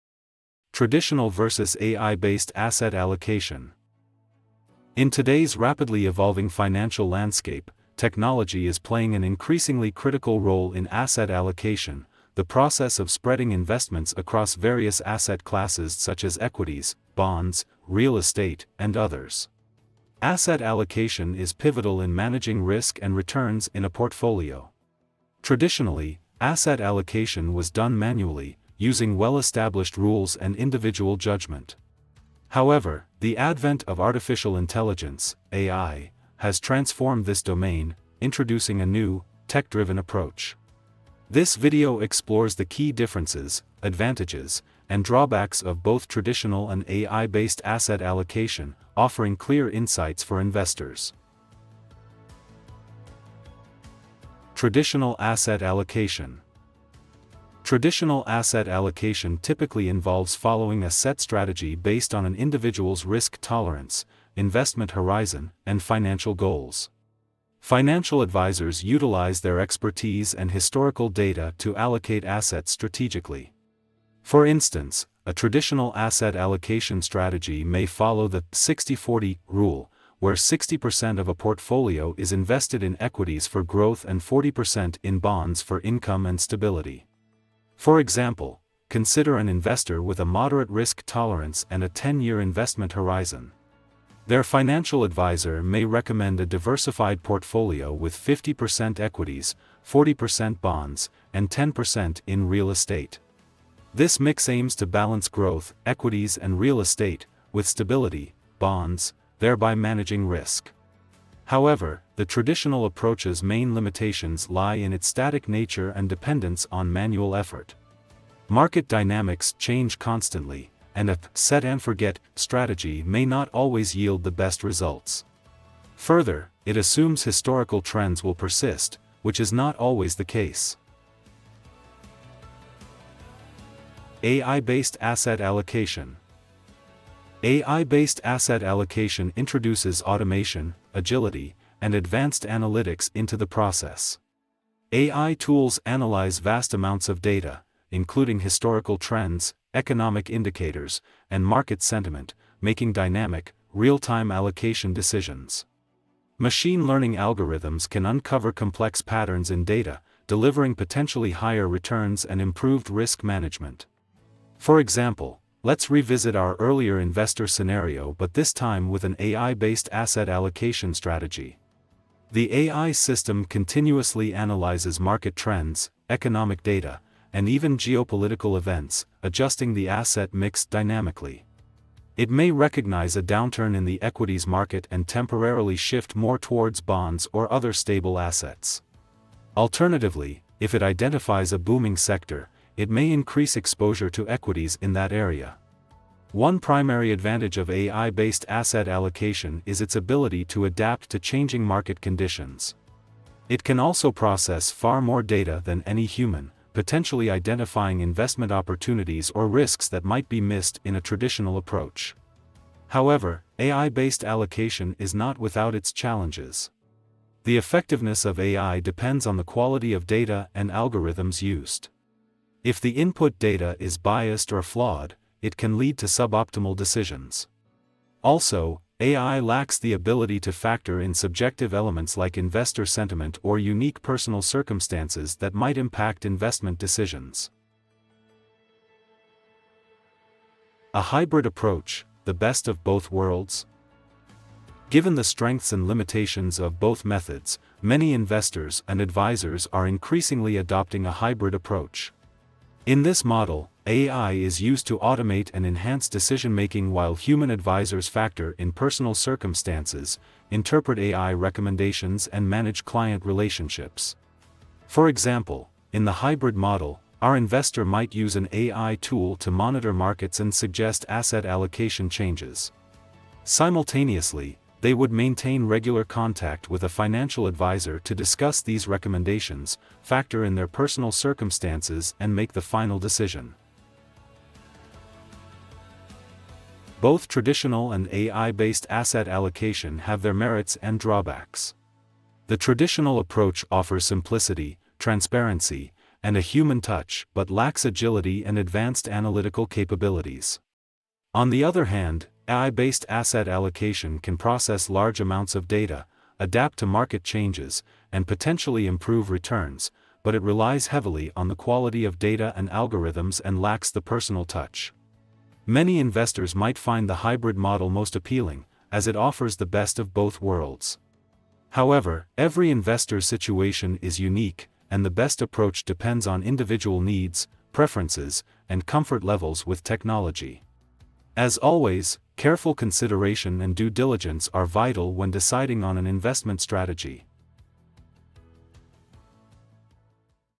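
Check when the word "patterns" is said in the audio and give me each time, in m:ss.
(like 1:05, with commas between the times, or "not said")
2:39.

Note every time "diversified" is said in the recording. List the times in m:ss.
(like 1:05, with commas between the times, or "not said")
1:36.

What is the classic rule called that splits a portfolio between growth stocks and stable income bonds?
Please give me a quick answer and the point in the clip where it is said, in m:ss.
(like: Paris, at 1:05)
60-40 rule, at 1:18.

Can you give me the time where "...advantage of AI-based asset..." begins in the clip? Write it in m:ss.
3:17.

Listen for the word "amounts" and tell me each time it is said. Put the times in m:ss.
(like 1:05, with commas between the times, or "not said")
2:26, 5:05.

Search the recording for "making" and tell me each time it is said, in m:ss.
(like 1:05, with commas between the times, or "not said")
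2:32, 4:16.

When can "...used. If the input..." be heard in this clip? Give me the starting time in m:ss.
3:41.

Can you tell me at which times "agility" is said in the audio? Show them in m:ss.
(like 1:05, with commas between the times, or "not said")
2:20, 4:57.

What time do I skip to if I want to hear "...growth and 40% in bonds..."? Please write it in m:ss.
1:23.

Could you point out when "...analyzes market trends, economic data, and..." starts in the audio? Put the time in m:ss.
2:54.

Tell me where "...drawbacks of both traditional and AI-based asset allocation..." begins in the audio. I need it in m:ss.
0:45.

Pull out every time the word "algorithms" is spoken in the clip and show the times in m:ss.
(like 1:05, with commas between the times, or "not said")
2:37, 3:40, 5:12.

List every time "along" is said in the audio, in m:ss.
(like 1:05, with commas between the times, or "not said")
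not said.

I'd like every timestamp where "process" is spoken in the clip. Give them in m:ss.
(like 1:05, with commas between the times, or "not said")
0:12, 2:23, 3:24, 5:04.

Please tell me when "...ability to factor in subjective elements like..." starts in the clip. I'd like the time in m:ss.
3:49.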